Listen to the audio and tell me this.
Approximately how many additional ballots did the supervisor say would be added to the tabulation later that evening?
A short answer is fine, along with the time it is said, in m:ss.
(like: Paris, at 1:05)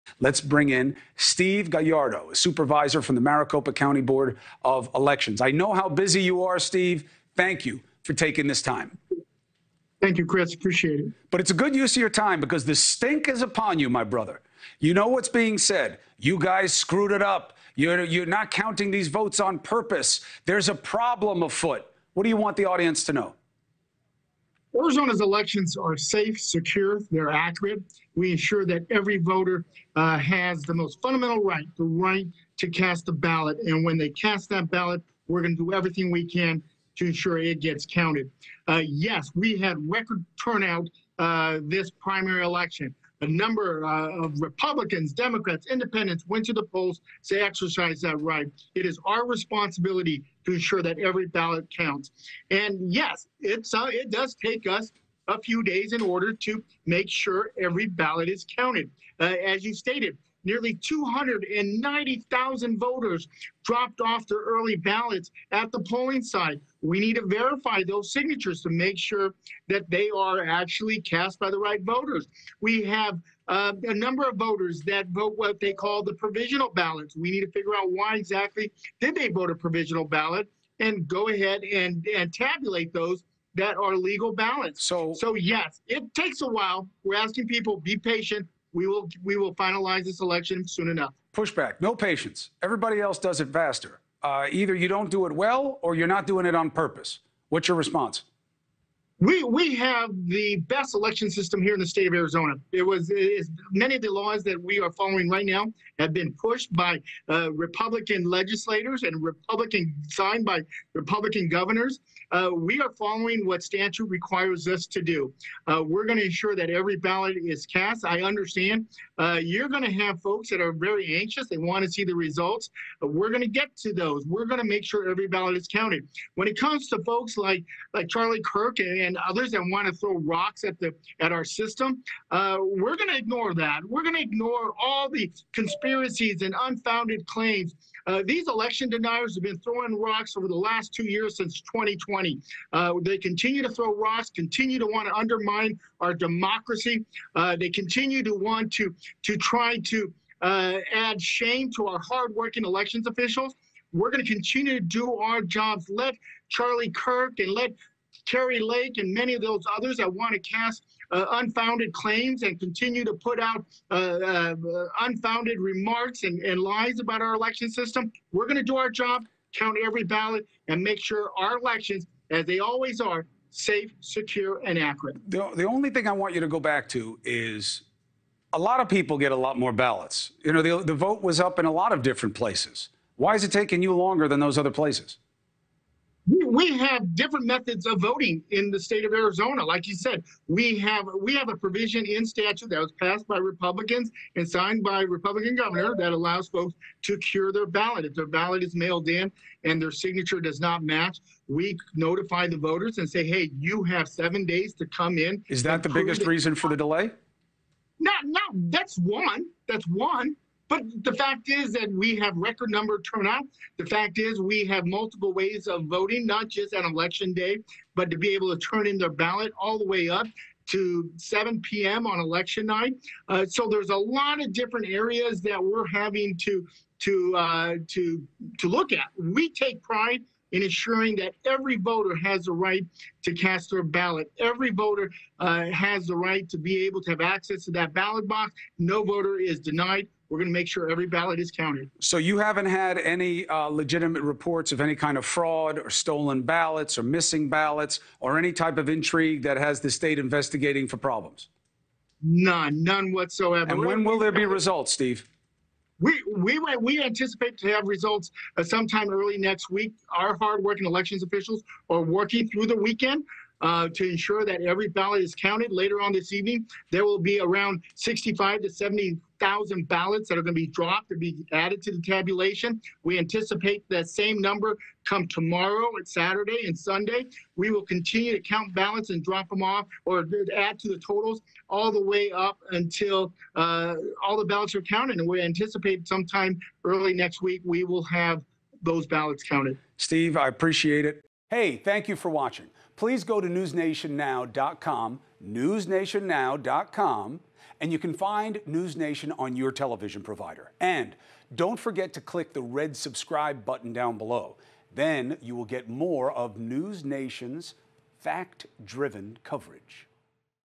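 65 to 70 thousand, at 4:27.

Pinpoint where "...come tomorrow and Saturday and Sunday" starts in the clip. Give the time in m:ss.
4:35.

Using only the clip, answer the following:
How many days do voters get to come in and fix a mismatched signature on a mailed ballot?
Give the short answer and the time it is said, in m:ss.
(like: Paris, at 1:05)
7, at 3:24.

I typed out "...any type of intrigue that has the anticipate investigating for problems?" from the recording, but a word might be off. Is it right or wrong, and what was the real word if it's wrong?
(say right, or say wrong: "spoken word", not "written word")
wrong: "state", not "anticipate".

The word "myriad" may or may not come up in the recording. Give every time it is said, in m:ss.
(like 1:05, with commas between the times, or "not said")
not said.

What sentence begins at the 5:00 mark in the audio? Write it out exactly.
And don't forget to click the red subscribe button down below.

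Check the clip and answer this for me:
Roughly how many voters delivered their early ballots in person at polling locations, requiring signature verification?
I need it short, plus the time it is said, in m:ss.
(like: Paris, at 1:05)
290,000, at 1:00.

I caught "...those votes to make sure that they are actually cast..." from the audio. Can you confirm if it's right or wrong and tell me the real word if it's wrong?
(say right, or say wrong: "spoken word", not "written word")
wrong: "signatures", not "votes".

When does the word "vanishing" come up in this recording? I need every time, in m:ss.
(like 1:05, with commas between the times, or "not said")
not said.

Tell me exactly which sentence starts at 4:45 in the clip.
And we anticipate sometime early next week we will have those ballots counted.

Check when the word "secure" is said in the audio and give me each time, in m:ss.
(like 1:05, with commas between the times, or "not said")
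0:26, 2:53.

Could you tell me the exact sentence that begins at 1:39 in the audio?
We, we have the best election system here in the state of Arizona.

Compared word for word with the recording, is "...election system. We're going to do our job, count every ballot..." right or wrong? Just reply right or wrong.
right.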